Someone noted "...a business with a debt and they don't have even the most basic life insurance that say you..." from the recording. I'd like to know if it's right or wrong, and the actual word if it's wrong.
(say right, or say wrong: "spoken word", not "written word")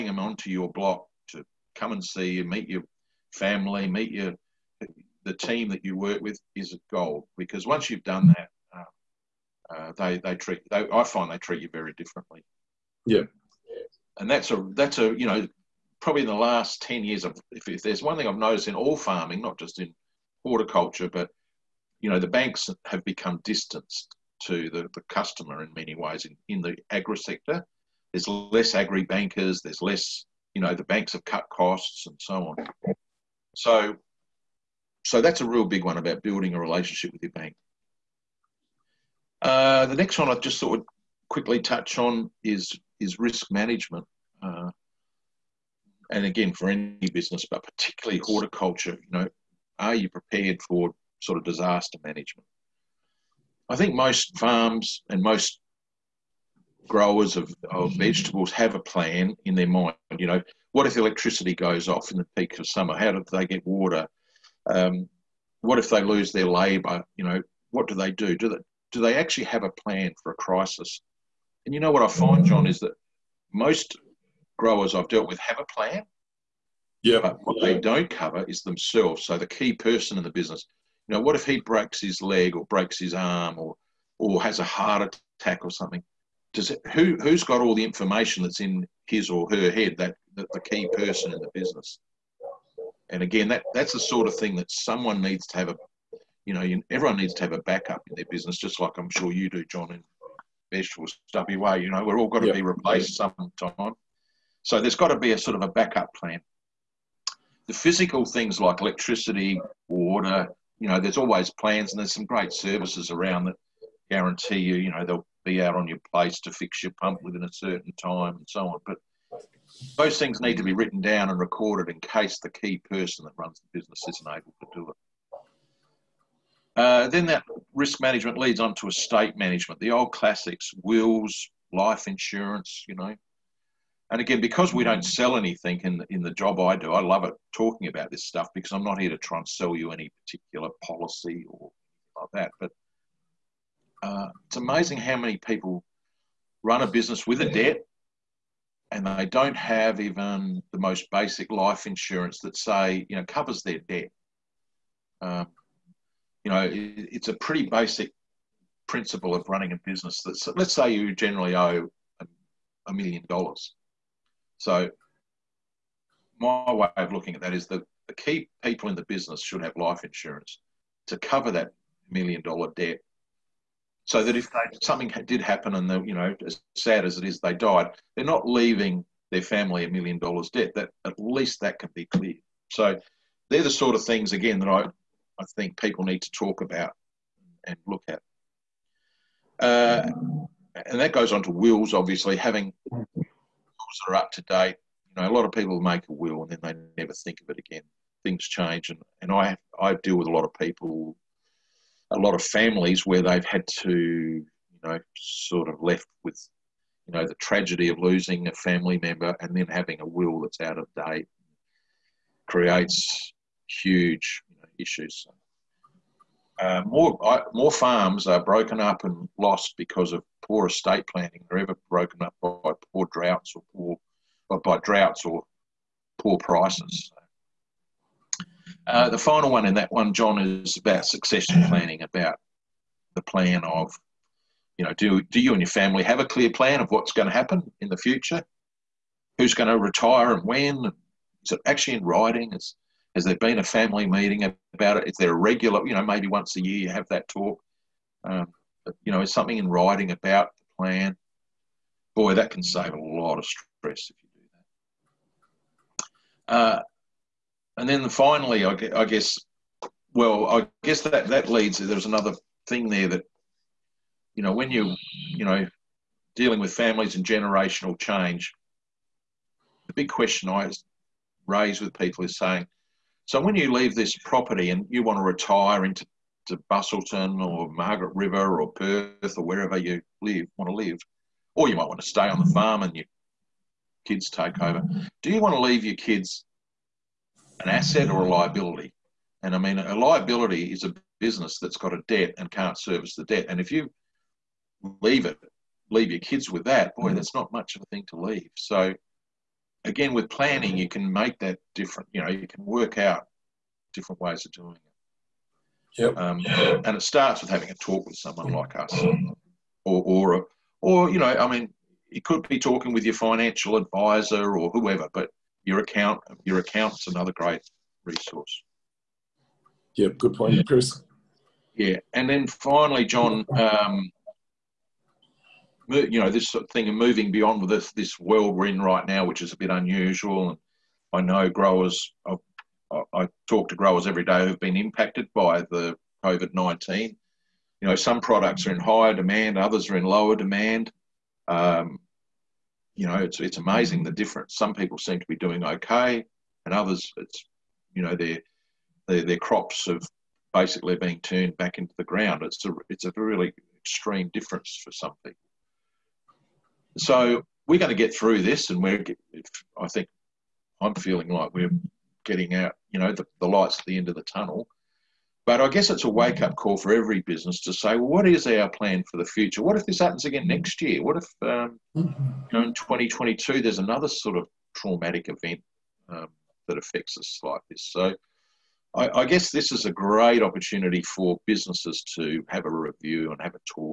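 right.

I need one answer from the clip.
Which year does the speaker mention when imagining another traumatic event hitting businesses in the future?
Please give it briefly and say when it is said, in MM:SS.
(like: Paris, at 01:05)
2022, at 06:12.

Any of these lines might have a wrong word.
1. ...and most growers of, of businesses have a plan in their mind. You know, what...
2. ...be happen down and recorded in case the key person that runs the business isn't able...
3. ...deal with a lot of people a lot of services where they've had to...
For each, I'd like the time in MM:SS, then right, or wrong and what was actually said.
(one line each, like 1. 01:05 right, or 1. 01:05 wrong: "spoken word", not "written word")
1. 00:55 wrong: "vegetables", not "businesses"
2. 02:00 wrong: "written", not "happen"
3. 03:20 wrong: "families", not "services".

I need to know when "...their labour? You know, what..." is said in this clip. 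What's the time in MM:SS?
01:06.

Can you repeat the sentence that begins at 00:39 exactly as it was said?
Uh, the next one I just thought would quickly touch on is is risk management.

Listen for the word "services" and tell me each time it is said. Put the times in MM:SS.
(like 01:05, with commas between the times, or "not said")
01:52, 04:52.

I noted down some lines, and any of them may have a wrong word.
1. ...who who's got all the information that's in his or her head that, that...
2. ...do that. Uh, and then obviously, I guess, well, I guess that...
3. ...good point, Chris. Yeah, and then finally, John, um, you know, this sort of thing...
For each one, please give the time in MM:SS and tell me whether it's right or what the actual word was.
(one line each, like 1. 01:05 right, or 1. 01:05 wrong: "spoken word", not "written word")
1. 01:26 right
2. 04:14 wrong: "finally", not "obviously"
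3. 05:20 right.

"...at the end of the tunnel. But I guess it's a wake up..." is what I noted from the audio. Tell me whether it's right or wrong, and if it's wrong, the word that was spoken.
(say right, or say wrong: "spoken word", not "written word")
right.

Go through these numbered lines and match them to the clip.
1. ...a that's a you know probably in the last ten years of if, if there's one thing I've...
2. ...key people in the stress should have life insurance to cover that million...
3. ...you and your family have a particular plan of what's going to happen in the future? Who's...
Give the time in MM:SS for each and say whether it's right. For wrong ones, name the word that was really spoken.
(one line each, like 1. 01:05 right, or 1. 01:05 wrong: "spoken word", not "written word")
1. 00:14 right
2. 02:48 wrong: "business", not "stress"
3. 03:55 wrong: "clear", not "particular".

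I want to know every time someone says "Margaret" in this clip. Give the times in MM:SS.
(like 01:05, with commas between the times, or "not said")
04:37.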